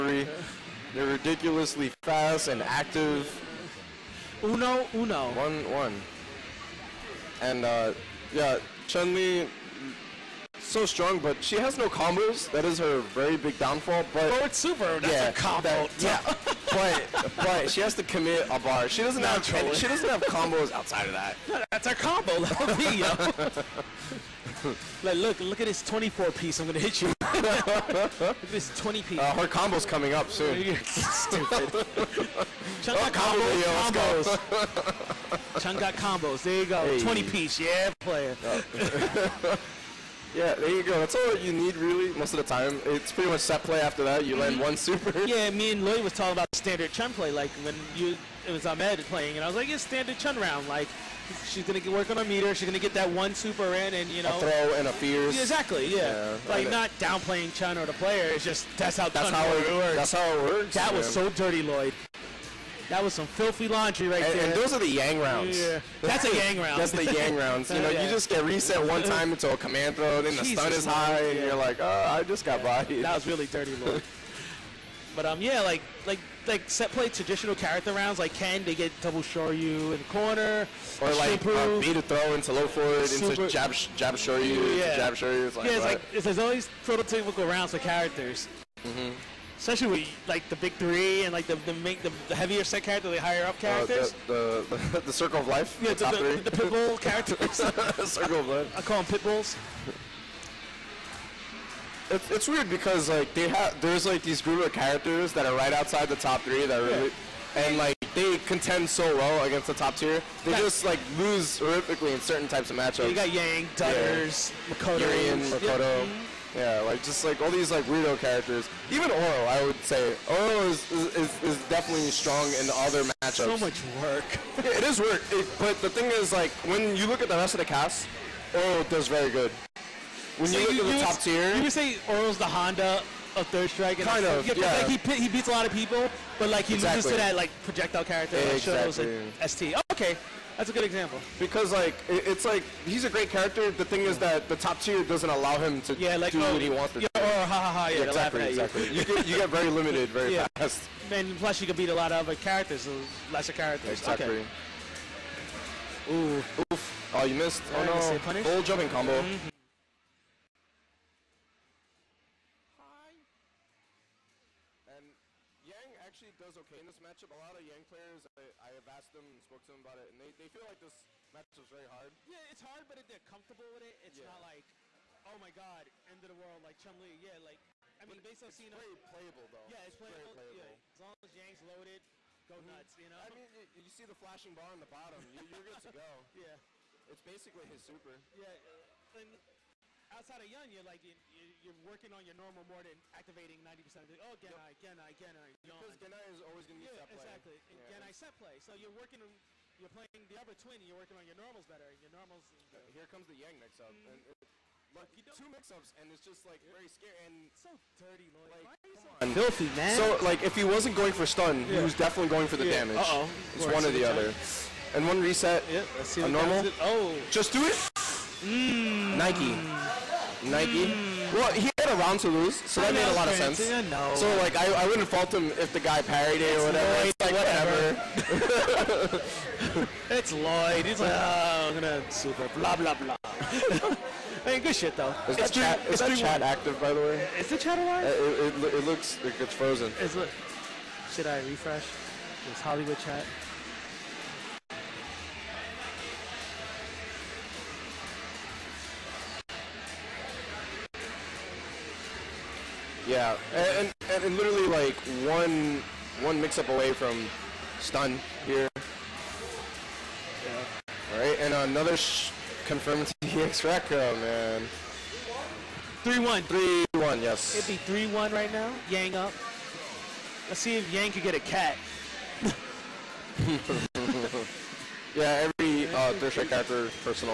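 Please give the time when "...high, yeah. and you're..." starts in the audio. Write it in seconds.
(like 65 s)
70 s.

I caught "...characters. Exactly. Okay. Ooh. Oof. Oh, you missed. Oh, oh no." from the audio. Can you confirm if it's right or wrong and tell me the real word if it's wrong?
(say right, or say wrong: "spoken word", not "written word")
right.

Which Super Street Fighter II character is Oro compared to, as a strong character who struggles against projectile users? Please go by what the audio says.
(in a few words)
Honda.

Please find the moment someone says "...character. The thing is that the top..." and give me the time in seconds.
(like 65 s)
143 s.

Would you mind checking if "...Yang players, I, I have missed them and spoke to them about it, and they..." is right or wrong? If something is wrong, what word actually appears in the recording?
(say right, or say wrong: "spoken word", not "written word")
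wrong: "asked", not "missed".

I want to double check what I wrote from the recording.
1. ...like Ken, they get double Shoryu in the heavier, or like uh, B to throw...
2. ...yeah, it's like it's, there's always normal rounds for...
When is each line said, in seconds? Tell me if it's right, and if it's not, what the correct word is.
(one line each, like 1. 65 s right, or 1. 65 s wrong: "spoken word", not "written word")
1. 78 s wrong: "corner", not "heavier"
2. 85 s wrong: "prototypical", not "normal".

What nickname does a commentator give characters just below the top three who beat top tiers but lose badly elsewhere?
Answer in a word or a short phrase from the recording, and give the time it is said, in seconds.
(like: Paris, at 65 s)
pitbulls, at 98 s.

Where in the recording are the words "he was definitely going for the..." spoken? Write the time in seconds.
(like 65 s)
211 s.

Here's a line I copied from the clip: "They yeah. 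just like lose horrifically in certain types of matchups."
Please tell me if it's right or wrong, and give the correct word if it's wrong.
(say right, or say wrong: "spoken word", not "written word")
right.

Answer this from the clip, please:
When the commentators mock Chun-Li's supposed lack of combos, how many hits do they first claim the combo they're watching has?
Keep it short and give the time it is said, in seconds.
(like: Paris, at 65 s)
24, at 25 s.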